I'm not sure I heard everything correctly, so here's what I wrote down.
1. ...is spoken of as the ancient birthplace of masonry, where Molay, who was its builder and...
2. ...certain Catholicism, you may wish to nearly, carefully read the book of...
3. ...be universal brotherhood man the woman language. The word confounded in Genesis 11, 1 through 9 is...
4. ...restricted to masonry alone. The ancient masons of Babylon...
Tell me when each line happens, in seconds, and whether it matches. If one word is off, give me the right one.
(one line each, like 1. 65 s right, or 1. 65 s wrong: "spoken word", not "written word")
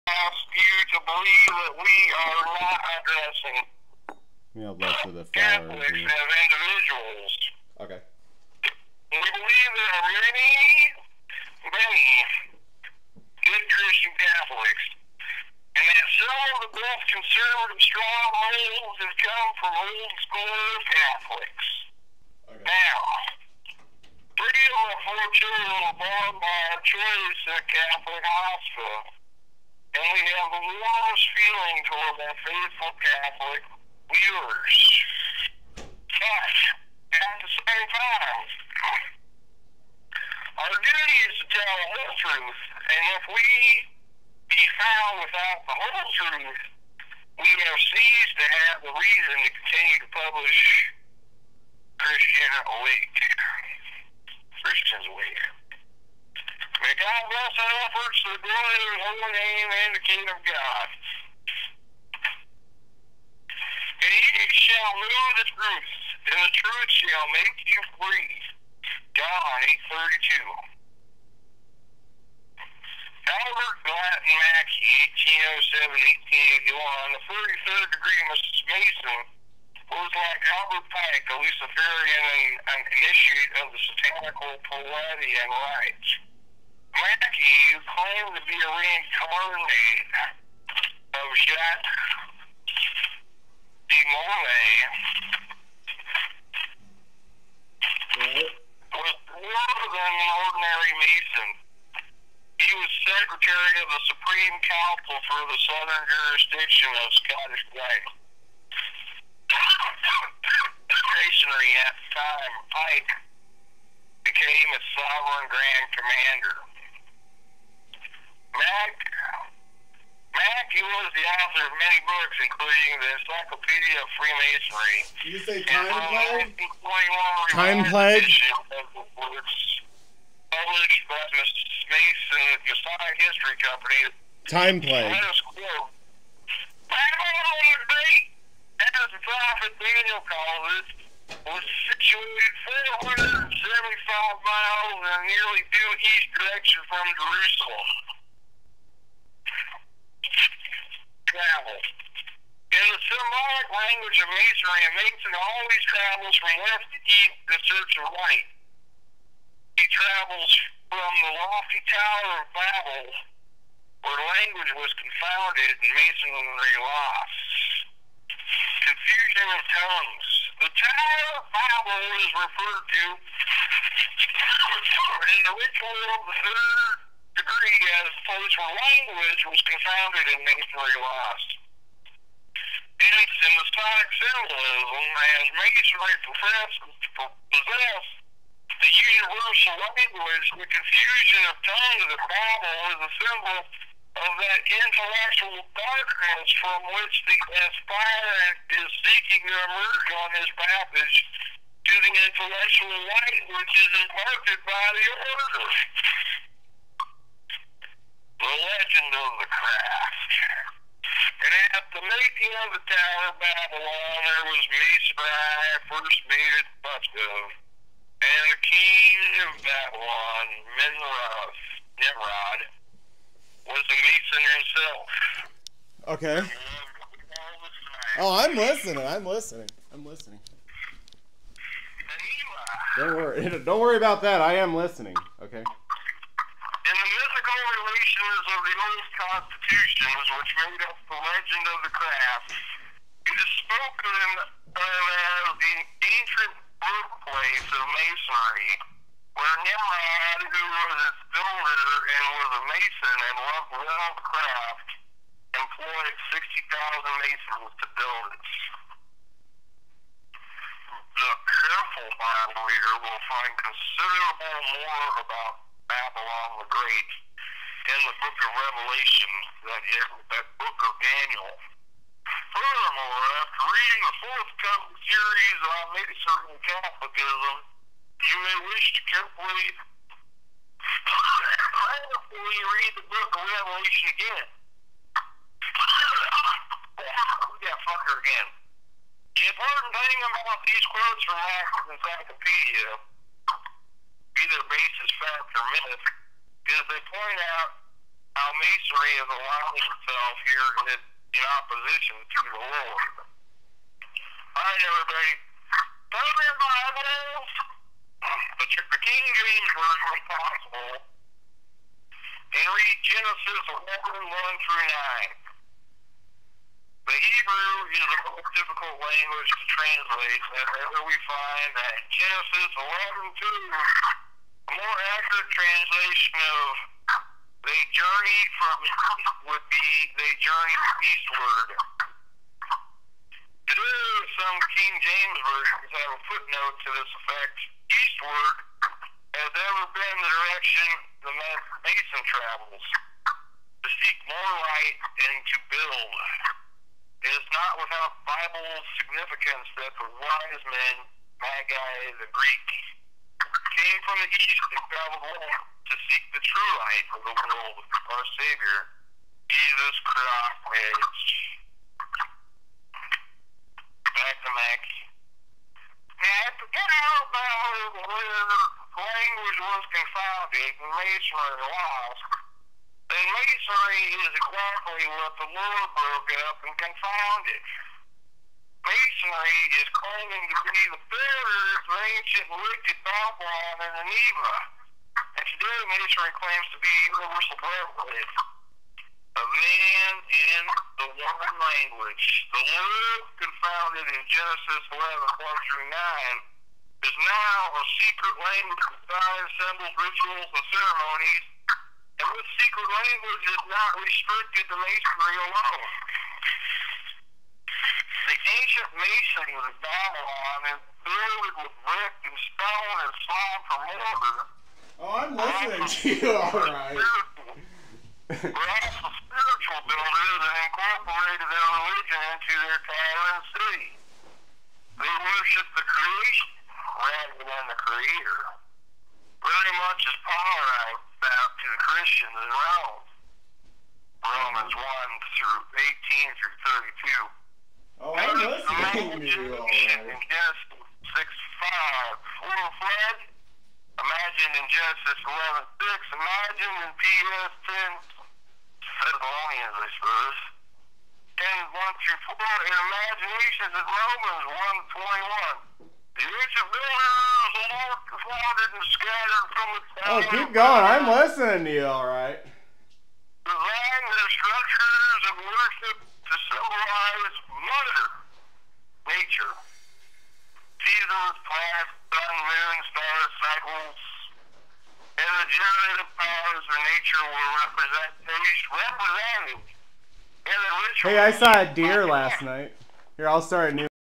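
1. 243 s wrong: "Nimrod", not "Molay"
2. 276 s wrong: "carefully", not "nearly"
3. 386 s right
4. 403 s right.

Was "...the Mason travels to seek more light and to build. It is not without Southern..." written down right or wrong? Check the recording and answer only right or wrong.
wrong.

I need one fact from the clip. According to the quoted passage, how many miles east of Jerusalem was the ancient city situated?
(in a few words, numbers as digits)
475.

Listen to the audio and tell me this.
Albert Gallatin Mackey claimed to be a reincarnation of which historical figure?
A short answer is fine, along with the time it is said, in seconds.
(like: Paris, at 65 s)
Jacques de Molay, at 91 s.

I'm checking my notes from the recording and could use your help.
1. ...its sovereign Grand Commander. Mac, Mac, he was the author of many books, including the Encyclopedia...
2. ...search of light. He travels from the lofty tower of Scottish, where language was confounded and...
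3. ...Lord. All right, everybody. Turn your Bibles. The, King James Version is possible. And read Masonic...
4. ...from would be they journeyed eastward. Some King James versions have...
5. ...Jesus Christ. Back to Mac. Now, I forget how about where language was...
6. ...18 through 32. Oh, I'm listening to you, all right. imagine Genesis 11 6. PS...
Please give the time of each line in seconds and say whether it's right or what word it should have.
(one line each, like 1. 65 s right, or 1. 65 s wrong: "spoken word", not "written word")
1. 114 s right
2. 157 s wrong: "Babel", not "Scottish"
3. 302 s wrong: "Genesis", not "Masonic"
4. 328 s right
5. 359 s right
6. 435 s right.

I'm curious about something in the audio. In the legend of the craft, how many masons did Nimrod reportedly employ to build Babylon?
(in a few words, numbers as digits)
60,000.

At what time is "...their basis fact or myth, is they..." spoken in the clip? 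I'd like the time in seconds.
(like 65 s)
294 s.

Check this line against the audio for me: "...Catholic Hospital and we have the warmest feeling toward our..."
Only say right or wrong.
right.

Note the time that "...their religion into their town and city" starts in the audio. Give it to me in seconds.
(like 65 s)
421 s.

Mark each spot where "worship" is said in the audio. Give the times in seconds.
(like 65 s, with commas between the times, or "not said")
425 s, 465 s.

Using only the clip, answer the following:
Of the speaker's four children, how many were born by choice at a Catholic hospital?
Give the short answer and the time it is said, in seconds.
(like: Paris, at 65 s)
3, at 24 s.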